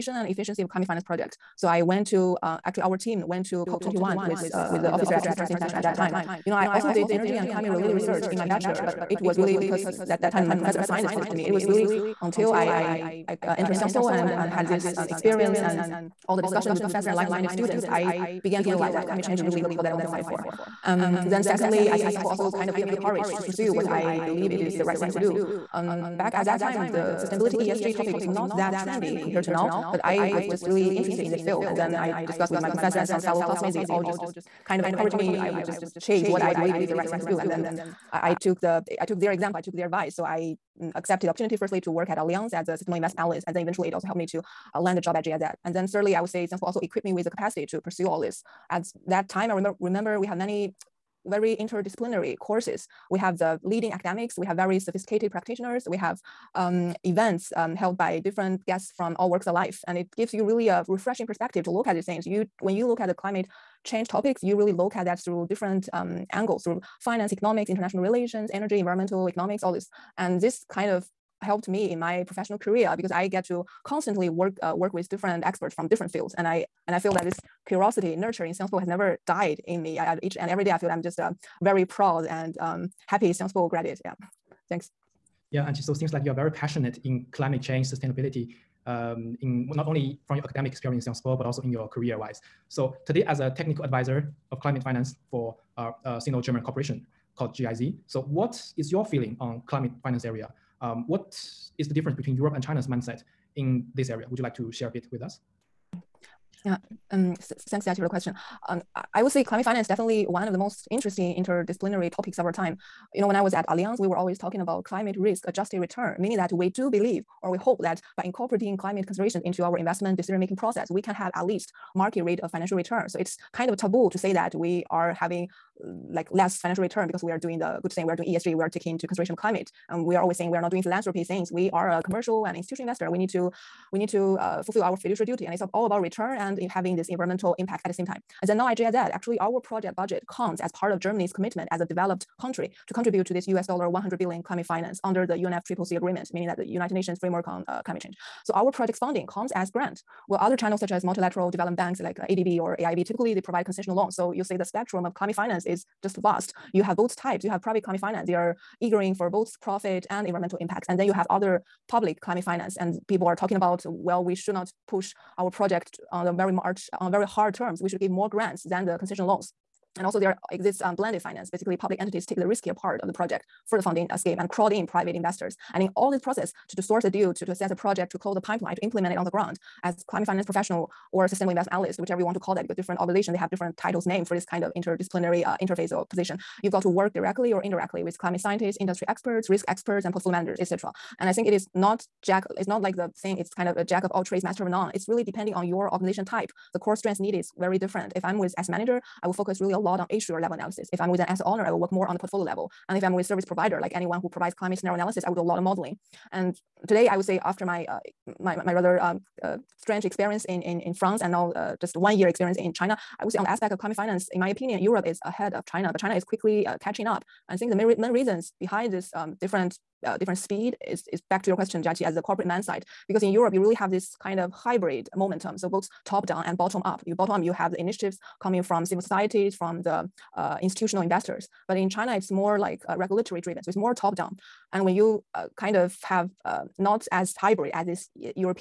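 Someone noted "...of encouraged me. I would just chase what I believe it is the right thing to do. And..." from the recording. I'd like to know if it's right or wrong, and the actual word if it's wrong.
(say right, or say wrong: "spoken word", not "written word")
right.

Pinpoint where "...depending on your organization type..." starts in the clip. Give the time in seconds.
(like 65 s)
195 s.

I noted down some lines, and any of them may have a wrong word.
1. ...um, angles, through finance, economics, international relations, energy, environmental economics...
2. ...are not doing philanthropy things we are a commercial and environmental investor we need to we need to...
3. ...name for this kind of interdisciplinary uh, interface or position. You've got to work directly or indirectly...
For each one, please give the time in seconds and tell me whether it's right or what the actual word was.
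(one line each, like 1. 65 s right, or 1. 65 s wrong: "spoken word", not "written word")
1. 65 s right
2. 130 s wrong: "institutional", not "environmental"
3. 184 s right.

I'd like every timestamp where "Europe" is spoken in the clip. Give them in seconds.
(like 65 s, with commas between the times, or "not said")
102 s, 214 s, 223 s.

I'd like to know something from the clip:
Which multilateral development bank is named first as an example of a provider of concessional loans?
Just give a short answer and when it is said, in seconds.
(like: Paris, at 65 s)
ADB, at 152 s.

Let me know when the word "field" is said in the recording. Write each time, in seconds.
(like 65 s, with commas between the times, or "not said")
31 s, 76 s.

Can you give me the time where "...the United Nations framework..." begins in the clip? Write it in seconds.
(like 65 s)
146 s.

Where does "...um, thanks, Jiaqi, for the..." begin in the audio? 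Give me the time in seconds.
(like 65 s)
107 s.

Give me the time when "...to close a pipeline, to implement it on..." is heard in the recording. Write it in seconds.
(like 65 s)
178 s.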